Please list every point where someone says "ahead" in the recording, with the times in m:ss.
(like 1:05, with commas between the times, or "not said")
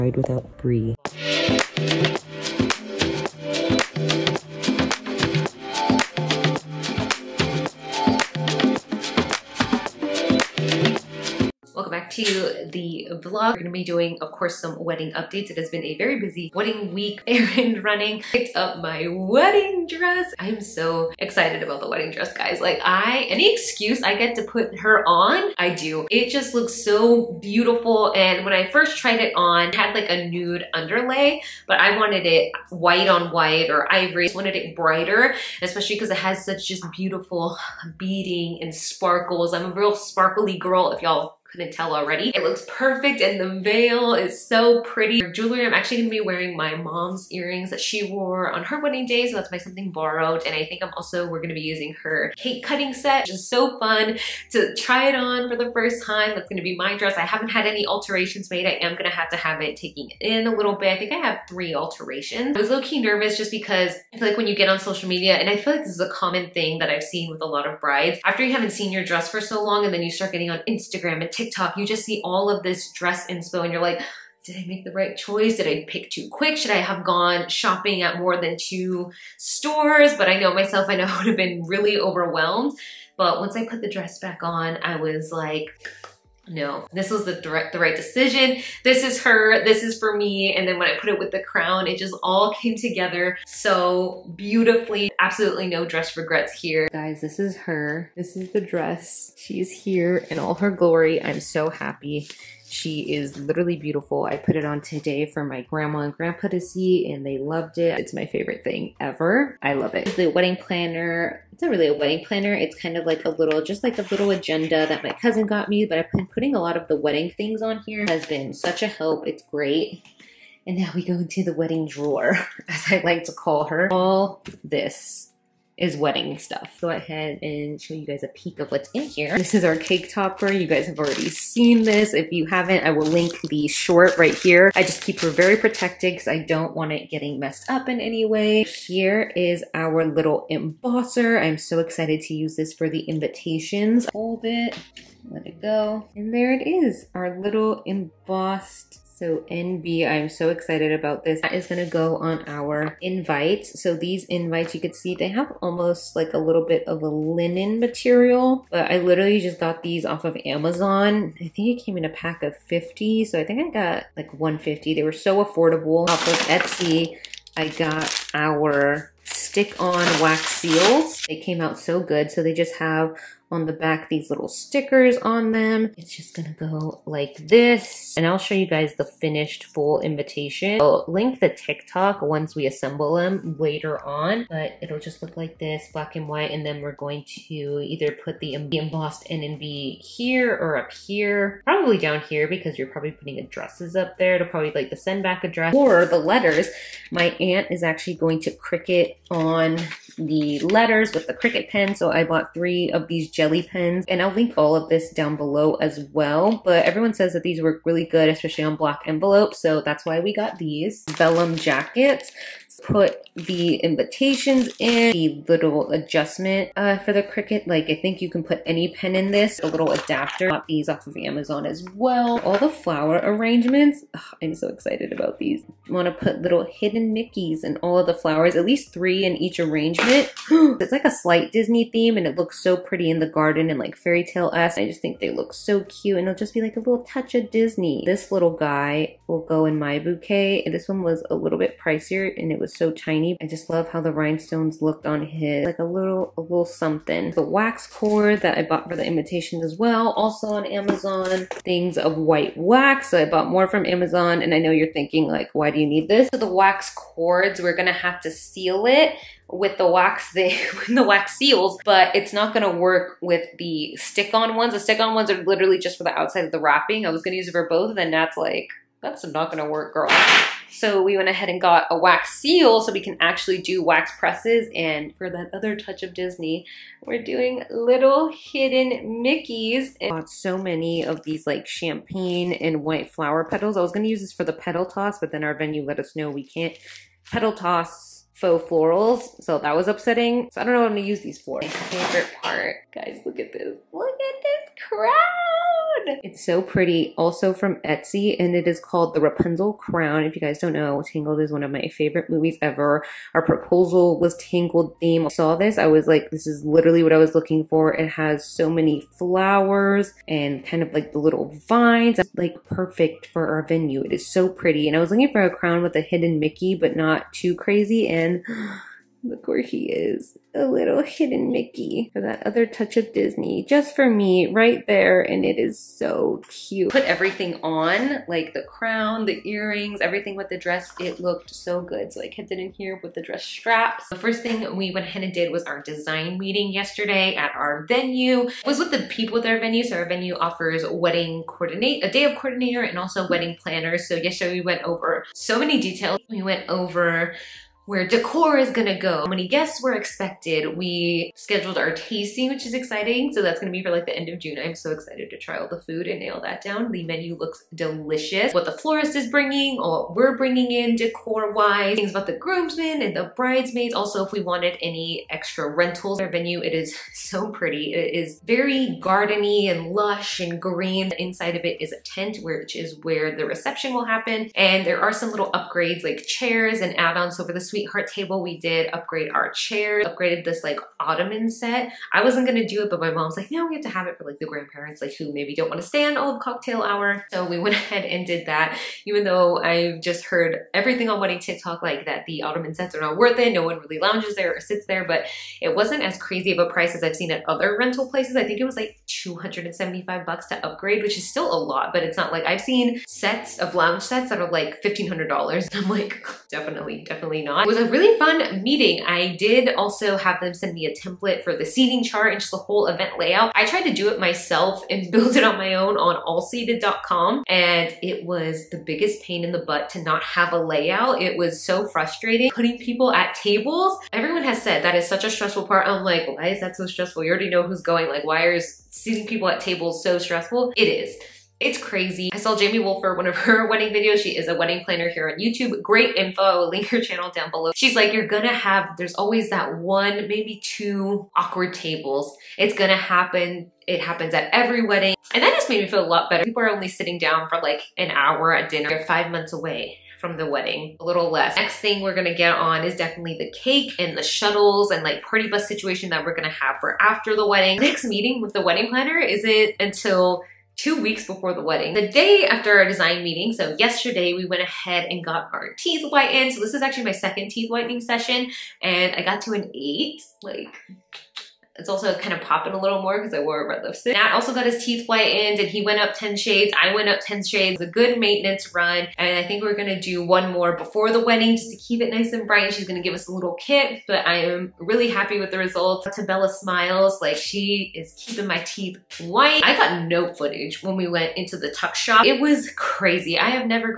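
2:06, 4:31, 5:35, 6:27, 7:44.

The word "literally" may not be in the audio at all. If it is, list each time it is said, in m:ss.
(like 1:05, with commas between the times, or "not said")
1:43, 2:38, 4:25, 5:06.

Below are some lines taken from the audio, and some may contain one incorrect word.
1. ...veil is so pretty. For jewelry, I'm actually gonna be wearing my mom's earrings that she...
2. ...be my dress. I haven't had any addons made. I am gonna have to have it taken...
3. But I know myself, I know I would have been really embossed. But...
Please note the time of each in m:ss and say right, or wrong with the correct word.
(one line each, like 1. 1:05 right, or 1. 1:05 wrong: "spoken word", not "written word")
1. 0:43 right
2. 0:56 wrong: "alterations", not "addons"
3. 1:20 wrong: "overwhelmed", not "embossed".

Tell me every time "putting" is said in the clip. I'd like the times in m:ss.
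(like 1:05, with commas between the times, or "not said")
1:56, 3:13, 7:02.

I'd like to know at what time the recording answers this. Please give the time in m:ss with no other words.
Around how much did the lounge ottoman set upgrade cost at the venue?
6:39.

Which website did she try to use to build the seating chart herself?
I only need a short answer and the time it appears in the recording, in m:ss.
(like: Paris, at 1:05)
allseated.com, at 6:56.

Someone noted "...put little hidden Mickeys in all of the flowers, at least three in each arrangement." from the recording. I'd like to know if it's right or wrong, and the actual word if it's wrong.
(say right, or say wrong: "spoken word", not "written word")
right.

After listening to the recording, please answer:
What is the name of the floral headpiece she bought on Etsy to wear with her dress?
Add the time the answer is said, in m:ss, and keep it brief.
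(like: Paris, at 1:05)
Rapunzel Crown, at 4:59.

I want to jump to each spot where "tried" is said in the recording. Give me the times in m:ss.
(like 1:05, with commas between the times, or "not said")
0:28, 6:53.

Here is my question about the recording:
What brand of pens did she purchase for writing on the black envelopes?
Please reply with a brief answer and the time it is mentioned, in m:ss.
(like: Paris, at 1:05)
Gelly pens, at 3:23.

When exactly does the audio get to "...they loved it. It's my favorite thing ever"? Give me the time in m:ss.
1:47.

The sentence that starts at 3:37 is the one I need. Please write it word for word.
Like I think you can put any pen in this, a little adapter.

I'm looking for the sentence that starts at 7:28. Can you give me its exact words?
They're five months away from the wedding, a little less.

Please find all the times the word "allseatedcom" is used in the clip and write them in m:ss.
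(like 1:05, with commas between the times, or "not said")
6:56.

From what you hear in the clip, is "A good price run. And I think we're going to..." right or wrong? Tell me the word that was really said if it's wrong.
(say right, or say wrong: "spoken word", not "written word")
wrong: "maintenance", not "price".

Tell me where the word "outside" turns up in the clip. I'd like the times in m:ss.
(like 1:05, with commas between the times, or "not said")
4:26.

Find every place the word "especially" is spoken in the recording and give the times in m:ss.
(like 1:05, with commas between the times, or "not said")
0:35, 3:28.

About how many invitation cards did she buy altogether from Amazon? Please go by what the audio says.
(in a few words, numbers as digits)
150.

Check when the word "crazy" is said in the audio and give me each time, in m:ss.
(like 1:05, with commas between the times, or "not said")
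5:17, 6:36, 7:11, 8:12.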